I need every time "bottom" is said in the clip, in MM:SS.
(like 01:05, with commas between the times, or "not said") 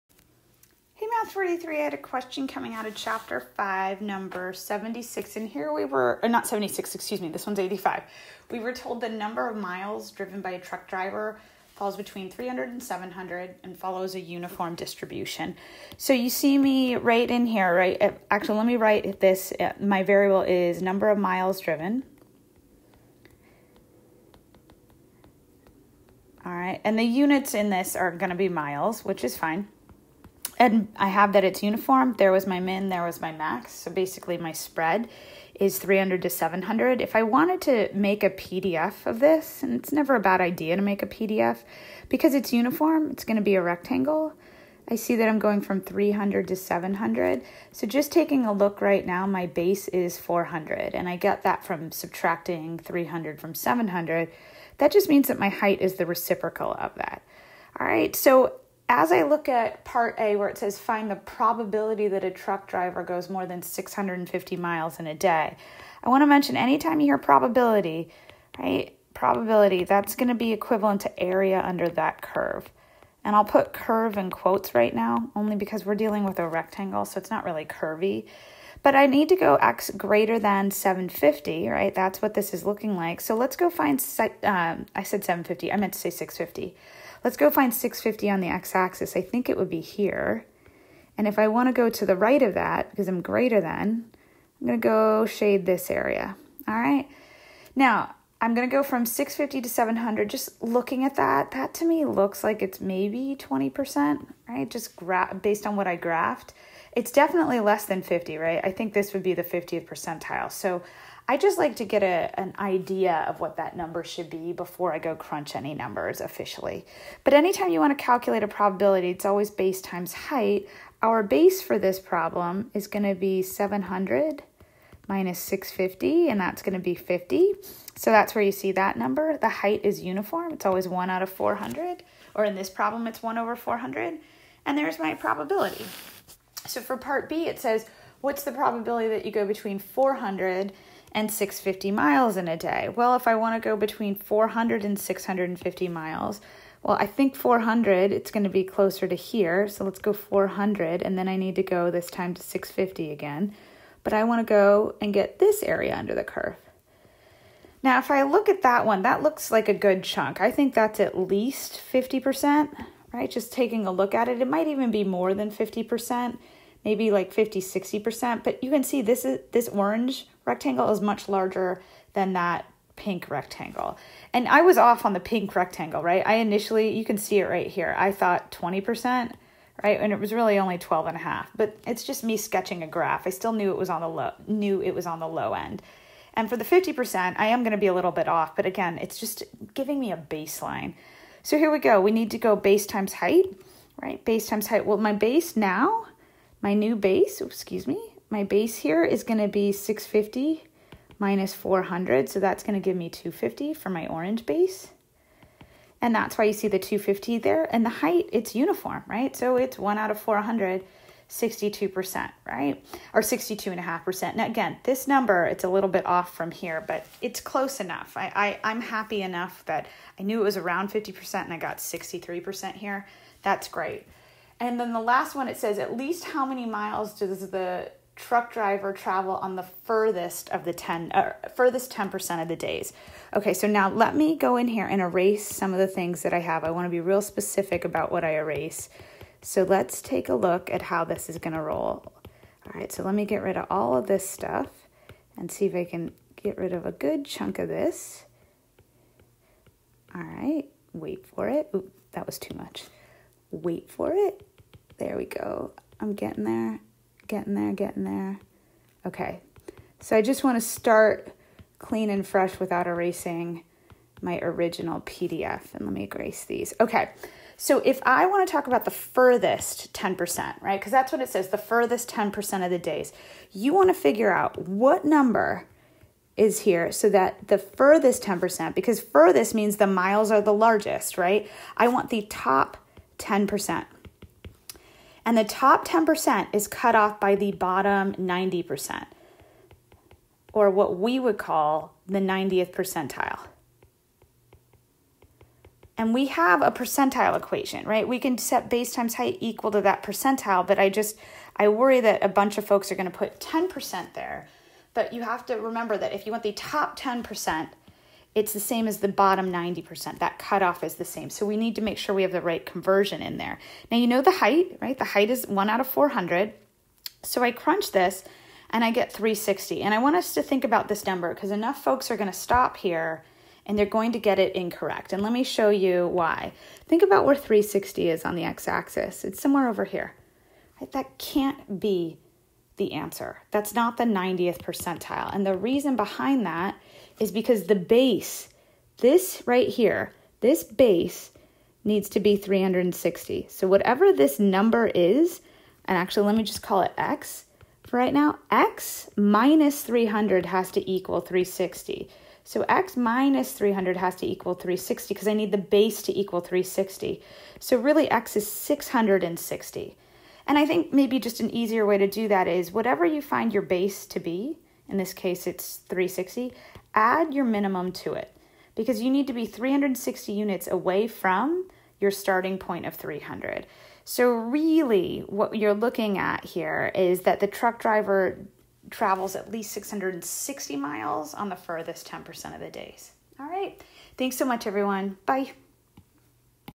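04:47, 05:09.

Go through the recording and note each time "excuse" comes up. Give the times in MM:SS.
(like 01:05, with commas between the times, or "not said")
00:06, 03:17.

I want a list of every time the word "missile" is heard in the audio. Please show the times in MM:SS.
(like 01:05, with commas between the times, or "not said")
not said.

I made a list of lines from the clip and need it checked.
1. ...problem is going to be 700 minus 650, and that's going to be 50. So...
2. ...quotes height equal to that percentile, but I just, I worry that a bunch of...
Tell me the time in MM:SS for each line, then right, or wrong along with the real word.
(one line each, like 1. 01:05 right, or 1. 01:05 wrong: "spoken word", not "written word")
1. 02:01 right
2. 04:58 wrong: "times", not "quotes".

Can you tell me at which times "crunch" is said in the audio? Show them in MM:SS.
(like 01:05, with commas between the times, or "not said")
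01:55, 05:17.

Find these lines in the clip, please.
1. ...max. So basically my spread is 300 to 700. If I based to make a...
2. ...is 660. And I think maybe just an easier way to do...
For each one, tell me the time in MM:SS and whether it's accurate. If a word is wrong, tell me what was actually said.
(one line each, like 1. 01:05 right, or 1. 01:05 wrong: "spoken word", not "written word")
1. 00:33 wrong: "wanted", not "based"
2. 05:58 right.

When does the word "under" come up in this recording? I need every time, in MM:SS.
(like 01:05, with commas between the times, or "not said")
01:11, 02:35.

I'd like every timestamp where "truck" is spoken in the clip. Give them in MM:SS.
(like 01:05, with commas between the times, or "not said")
00:10, 01:02, 03:48, 06:17.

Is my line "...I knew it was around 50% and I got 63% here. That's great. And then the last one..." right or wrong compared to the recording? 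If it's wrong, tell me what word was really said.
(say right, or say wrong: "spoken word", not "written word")
right.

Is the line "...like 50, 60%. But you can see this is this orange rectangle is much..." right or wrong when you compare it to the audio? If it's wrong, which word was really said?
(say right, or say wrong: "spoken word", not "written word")
right.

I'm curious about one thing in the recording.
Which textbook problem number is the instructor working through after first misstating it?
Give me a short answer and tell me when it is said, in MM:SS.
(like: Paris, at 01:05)
85, at 00:07.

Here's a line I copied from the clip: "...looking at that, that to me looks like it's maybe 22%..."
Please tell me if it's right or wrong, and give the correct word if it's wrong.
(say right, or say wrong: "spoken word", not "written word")
wrong: "20", not "22".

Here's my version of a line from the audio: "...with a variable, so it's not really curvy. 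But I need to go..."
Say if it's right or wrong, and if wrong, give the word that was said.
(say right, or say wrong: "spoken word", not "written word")
wrong: "rectangle", not "variable".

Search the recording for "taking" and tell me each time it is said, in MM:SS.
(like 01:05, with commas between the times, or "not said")
00:48, 02:43.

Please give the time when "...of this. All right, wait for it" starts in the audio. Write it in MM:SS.
04:07.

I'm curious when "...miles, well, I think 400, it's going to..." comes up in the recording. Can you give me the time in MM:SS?
02:25.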